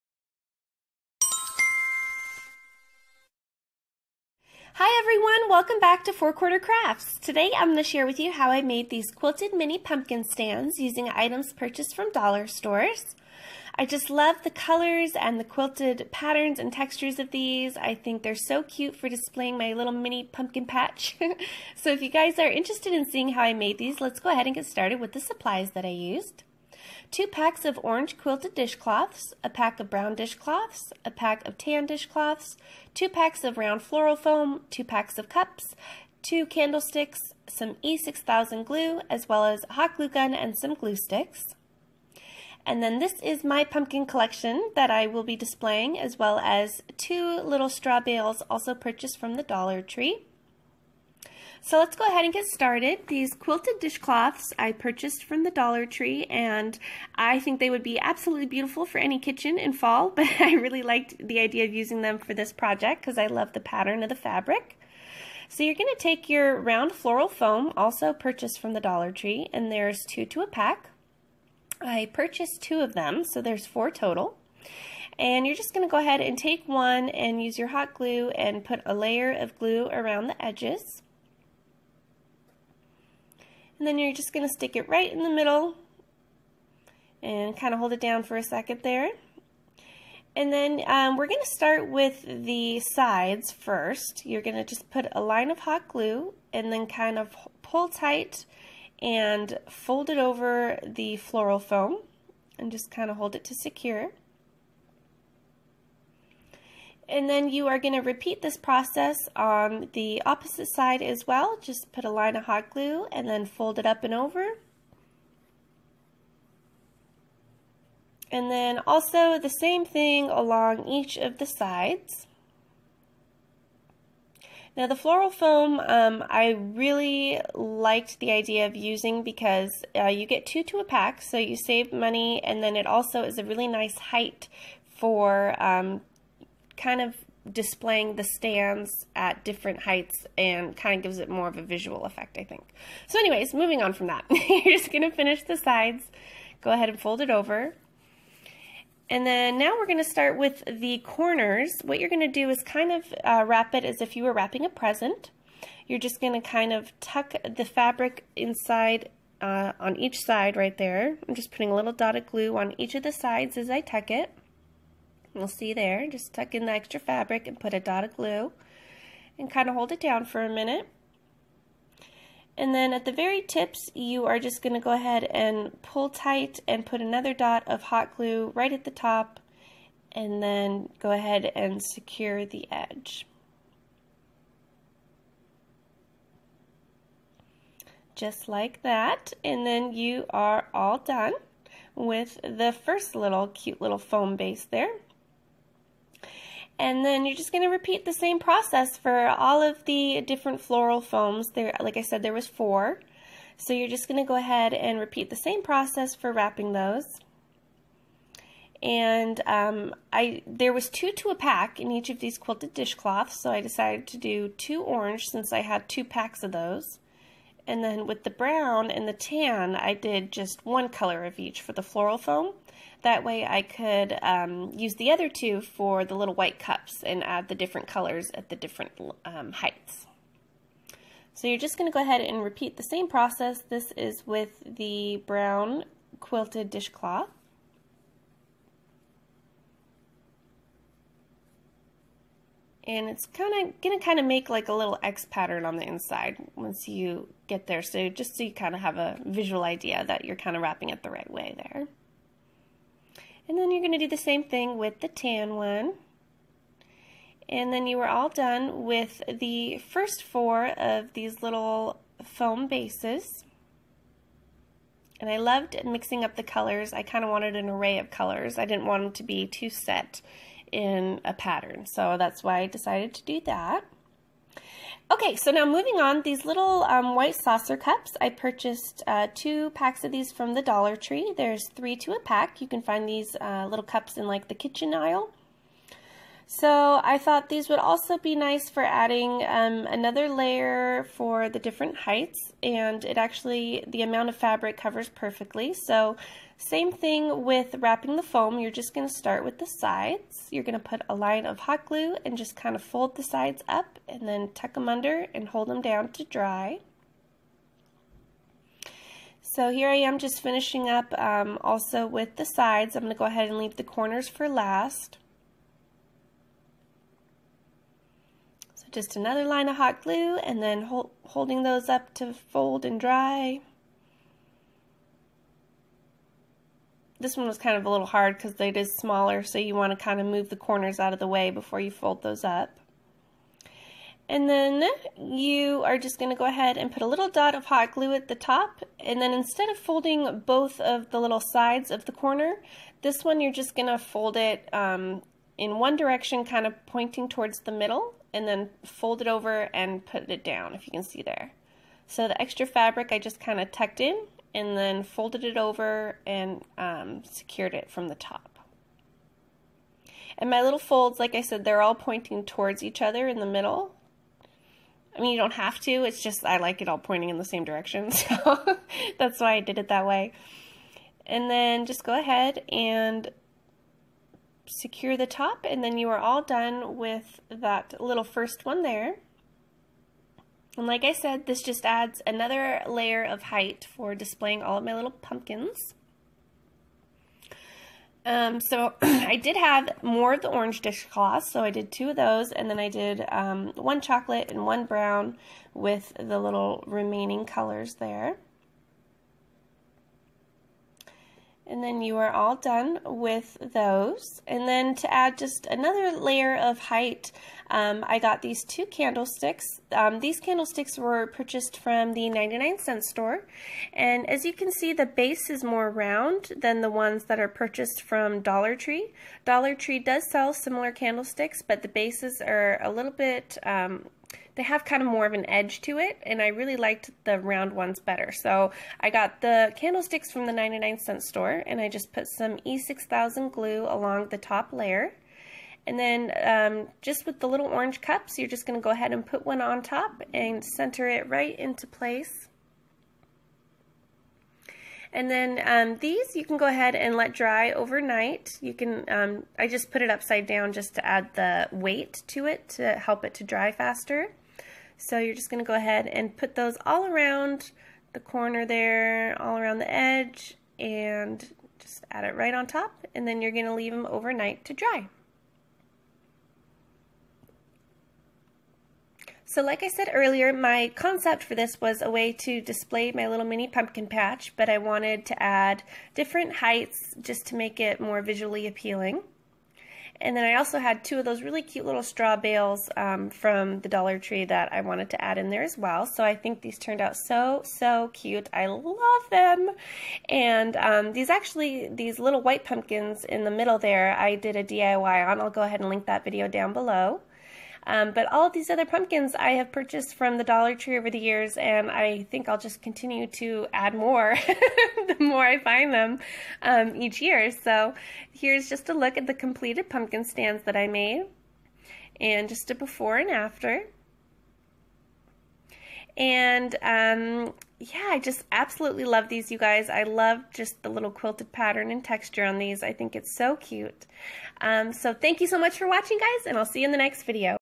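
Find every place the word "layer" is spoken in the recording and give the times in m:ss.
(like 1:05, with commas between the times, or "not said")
1:18, 4:50, 6:22, 6:46, 7:14.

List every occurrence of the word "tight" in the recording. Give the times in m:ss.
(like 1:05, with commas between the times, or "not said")
1:37, 2:56.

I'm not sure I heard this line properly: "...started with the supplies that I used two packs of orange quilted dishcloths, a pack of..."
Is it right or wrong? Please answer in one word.
right.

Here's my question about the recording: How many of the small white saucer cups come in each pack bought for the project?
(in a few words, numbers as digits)
3.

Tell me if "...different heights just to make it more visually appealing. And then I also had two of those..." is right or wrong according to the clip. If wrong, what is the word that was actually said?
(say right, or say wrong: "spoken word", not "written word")
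right.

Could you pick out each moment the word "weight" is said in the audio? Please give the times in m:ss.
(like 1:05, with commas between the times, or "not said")
7:31.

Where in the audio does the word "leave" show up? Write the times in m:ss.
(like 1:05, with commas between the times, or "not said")
5:13, 7:43.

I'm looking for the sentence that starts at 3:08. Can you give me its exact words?
Just like that, and then you are all done with the first little cute little foam base there.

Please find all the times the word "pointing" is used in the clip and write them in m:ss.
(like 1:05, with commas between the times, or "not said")
5:46, 6:01, 6:06.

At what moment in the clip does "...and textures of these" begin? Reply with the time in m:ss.
0:16.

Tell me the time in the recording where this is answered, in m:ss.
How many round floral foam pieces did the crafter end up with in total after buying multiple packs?
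1:13.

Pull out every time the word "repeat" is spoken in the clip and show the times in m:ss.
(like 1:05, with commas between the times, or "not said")
1:47, 3:17, 3:24, 3:52.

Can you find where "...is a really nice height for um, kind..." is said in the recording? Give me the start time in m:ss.
2:13.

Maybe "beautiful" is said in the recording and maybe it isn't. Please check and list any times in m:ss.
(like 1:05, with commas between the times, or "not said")
0:58.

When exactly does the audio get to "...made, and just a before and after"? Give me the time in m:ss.
8:30.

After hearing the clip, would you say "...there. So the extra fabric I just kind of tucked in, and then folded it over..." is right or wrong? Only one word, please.
right.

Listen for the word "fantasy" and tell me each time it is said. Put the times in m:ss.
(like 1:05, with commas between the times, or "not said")
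not said.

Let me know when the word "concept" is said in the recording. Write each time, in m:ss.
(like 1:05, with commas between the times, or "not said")
7:50.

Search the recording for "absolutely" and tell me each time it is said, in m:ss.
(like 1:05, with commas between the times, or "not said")
0:57, 8:38.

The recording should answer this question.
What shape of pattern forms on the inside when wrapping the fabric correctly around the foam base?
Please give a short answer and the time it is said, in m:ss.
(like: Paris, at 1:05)
X pattern, at 4:05.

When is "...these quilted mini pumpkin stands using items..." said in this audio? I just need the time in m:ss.
0:08.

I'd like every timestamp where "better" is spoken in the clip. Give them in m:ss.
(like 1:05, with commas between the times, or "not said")
7:07.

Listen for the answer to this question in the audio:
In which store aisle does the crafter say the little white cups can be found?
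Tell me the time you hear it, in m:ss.
4:44.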